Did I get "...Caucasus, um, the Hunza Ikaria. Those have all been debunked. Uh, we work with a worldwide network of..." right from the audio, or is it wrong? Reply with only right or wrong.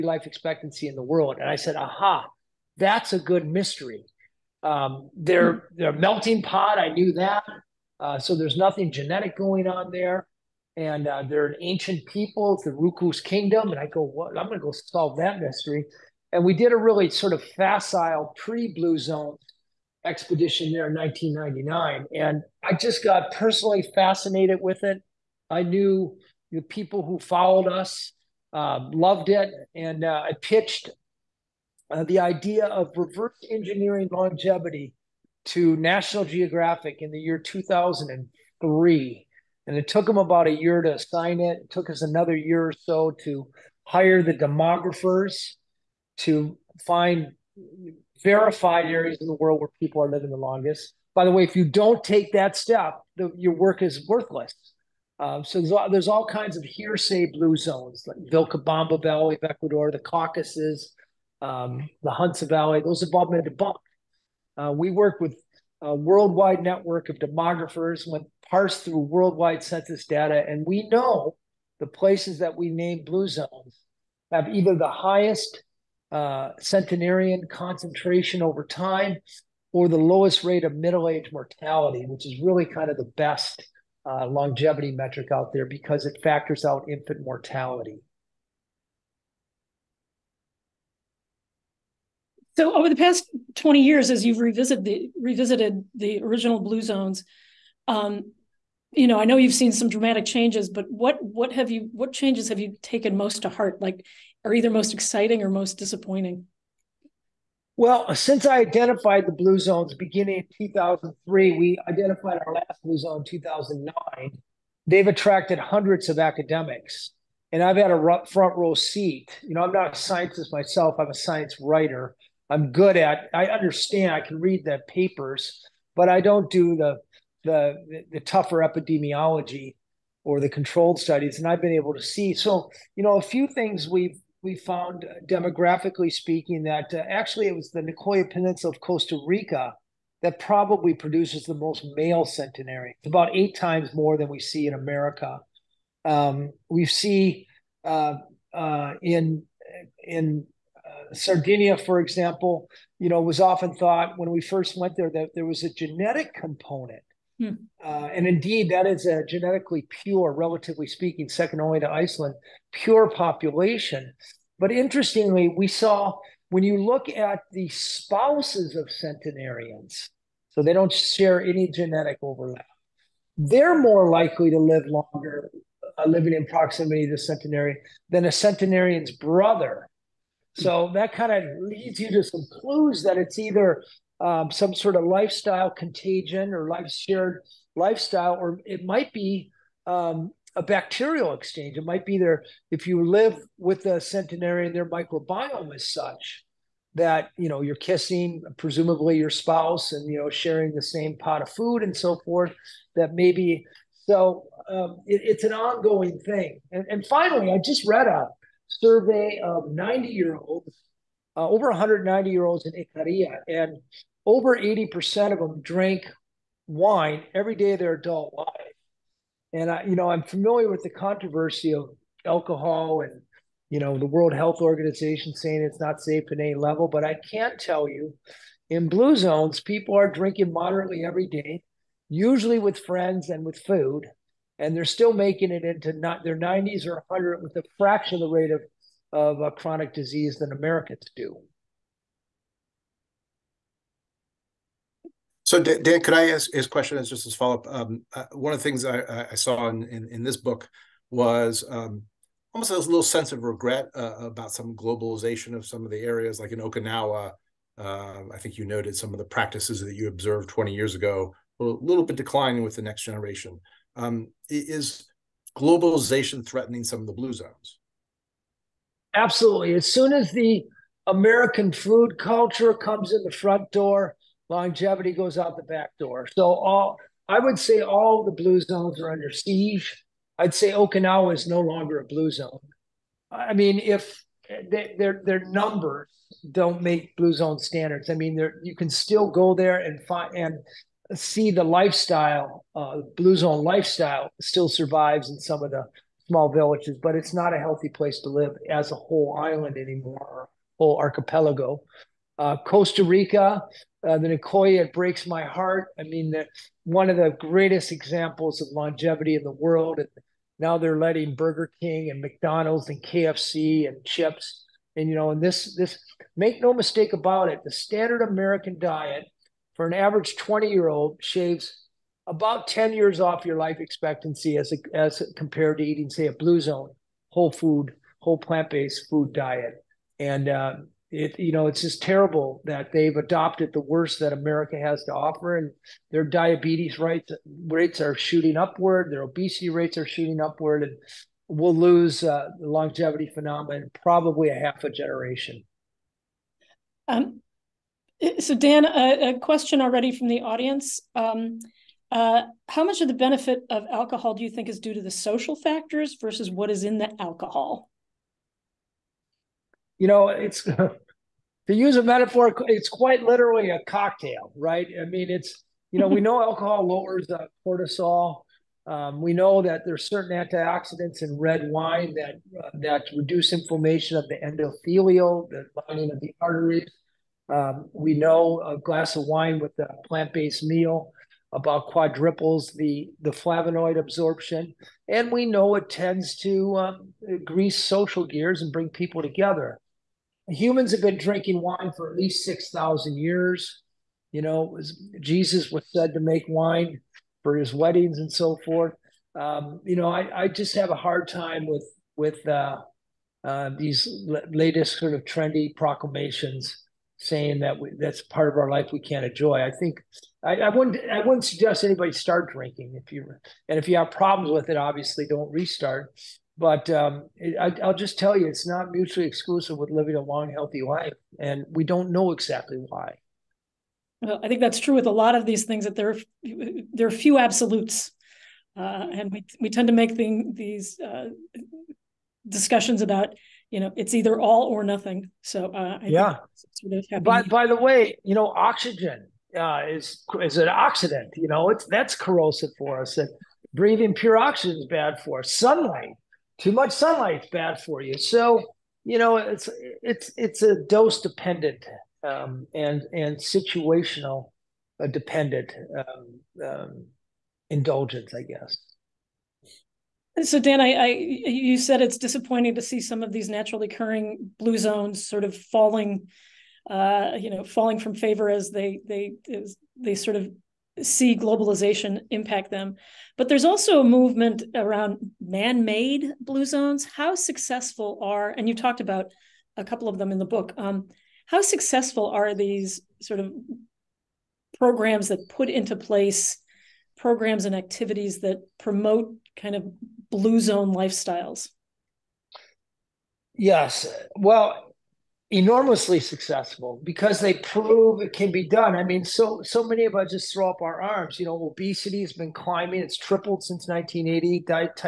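wrong.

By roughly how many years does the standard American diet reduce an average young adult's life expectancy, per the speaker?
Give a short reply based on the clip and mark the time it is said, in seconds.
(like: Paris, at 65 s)
10 years, at 322 s.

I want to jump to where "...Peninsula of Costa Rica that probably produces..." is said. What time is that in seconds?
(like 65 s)
138 s.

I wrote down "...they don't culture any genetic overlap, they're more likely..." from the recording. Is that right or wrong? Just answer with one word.
wrong.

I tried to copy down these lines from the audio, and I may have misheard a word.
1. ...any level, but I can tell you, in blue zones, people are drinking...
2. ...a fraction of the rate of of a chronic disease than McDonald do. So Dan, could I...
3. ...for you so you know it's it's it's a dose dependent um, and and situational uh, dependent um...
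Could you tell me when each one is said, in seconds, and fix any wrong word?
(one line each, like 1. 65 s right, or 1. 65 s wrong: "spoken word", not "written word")
1. 226 s right
2. 237 s wrong: "Americans", not "McDonald"
3. 447 s right.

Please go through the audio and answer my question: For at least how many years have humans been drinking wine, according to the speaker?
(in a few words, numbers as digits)
6,000 years.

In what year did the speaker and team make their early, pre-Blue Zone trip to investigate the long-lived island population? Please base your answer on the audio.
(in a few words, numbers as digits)
1999.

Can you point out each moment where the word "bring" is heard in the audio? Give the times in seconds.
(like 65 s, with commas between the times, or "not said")
388 s.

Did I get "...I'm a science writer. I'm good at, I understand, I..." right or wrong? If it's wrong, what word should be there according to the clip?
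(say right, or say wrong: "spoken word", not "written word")
right.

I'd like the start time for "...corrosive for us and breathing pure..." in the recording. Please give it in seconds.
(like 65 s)
442 s.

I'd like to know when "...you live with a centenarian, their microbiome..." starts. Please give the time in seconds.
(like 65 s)
192 s.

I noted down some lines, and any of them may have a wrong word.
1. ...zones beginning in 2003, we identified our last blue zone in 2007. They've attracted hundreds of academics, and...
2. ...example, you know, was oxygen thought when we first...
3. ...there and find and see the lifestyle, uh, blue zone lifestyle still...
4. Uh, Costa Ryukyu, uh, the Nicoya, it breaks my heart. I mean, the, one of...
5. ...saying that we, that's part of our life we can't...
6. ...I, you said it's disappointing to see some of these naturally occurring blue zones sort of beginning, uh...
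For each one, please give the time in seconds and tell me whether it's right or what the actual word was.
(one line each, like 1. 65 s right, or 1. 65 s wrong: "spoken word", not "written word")
1. 109 s wrong: "2009", not "2007"
2. 151 s wrong: "often", not "oxygen"
3. 289 s right
4. 302 s wrong: "Rica", not "Ryukyu"
5. 407 s right
6. 460 s wrong: "falling", not "beginning".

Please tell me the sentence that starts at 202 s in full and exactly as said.
That maybe so um, it, it's an ongoing thing.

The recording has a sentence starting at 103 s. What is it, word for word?
Like are either most exciting or most disappointing?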